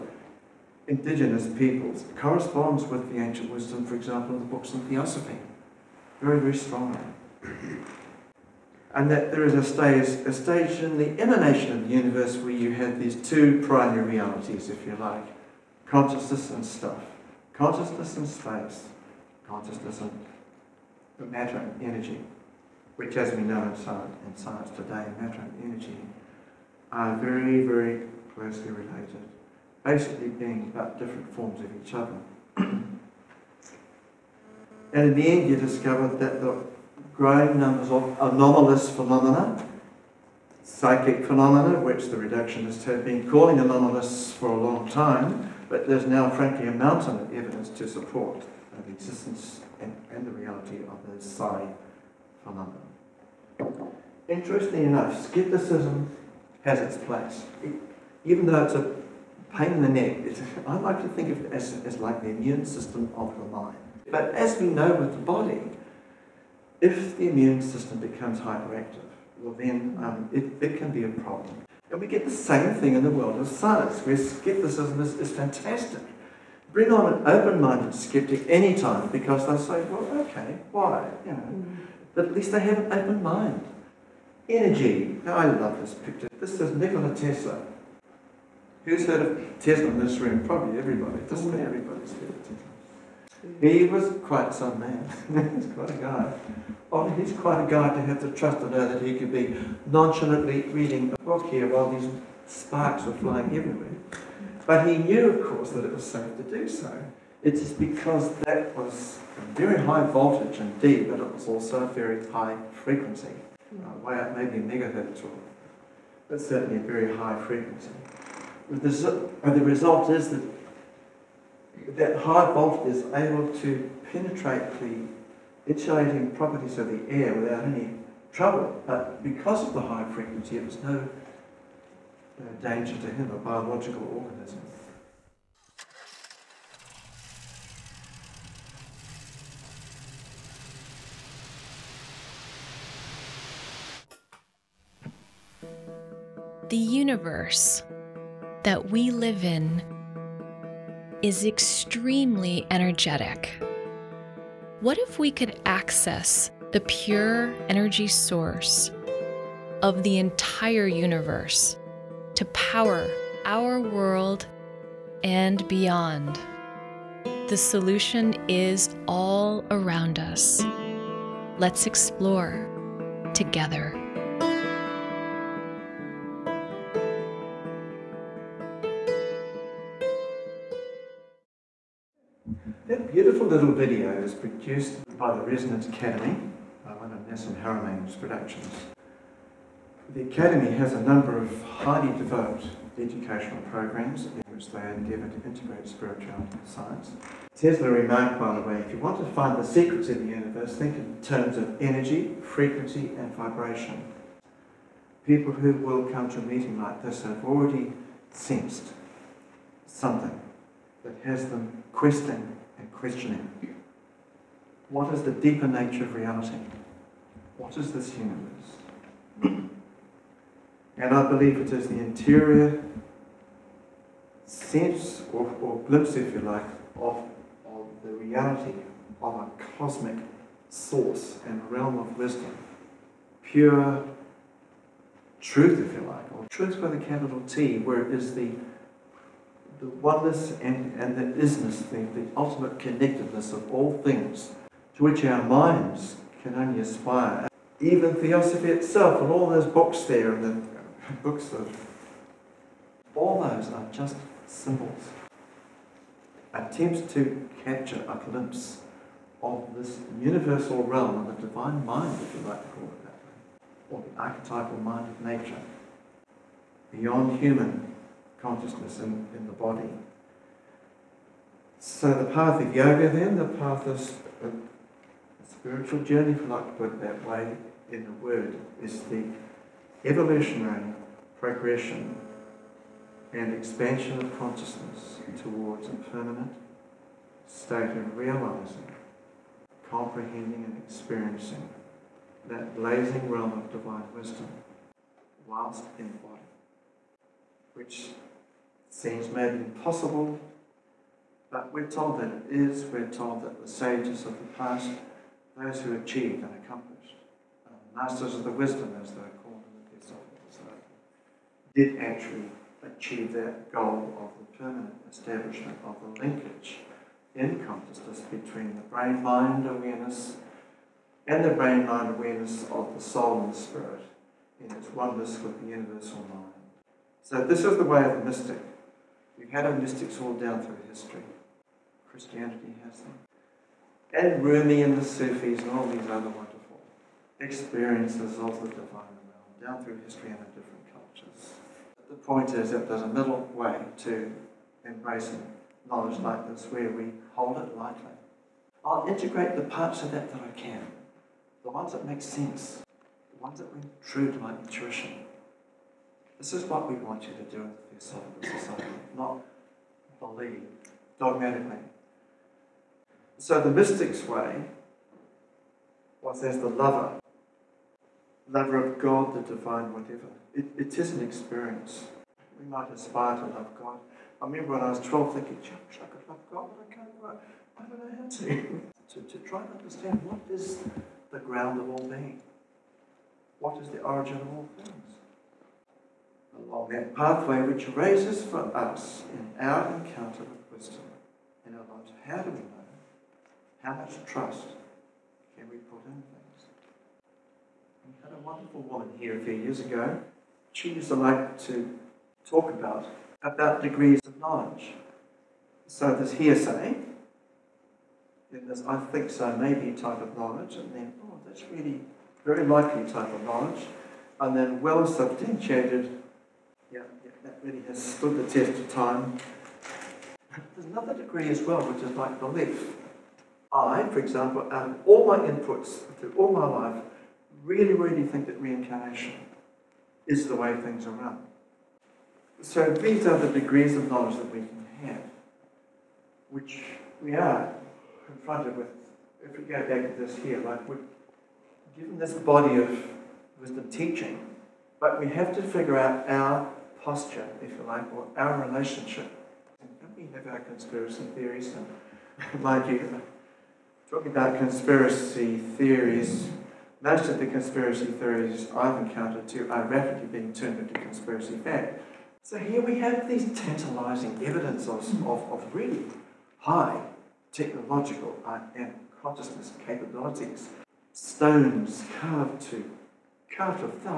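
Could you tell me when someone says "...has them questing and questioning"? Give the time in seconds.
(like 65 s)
211 s.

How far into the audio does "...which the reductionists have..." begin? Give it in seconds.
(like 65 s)
41 s.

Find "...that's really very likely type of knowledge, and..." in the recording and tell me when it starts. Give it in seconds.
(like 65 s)
411 s.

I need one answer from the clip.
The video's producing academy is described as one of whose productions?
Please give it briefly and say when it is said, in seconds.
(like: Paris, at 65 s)
Nassim Haramein, at 187 s.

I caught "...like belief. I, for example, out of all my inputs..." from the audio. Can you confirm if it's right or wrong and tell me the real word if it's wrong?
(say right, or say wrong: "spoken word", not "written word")
right.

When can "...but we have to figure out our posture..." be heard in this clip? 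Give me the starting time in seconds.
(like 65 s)
444 s.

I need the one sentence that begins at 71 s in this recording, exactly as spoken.
And we get the same thing in the world of science, where skepticism is, is fantastic.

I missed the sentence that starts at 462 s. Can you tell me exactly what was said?
So here we have these tantalizing evidence of, of, of really high technological and consciousness capabilities.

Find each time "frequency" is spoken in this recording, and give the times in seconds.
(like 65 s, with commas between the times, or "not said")
112 s, 117 s, 130 s, 202 s.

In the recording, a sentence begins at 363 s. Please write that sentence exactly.
So the mystic's way was as the lover, lover of God, the divine, whatever.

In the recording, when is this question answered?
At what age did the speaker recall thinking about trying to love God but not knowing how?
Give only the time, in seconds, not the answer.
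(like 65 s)
374 s.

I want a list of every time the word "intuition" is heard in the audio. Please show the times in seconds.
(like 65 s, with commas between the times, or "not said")
354 s.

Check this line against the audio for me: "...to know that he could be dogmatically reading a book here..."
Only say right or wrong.
wrong.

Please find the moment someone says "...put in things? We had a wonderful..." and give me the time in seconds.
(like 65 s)
395 s.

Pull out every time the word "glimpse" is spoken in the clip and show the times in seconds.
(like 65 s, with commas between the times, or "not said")
225 s, 258 s.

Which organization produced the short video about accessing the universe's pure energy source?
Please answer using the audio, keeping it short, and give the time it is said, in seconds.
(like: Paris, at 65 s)
Resonance Academy, at 185 s.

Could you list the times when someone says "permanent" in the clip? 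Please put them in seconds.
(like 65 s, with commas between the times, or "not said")
286 s, 314 s.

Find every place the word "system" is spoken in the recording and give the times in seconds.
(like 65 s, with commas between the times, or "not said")
62 s, 67 s.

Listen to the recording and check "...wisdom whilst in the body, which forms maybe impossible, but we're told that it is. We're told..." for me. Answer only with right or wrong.
wrong.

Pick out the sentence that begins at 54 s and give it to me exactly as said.
Interestingly enough, skepticism has its place.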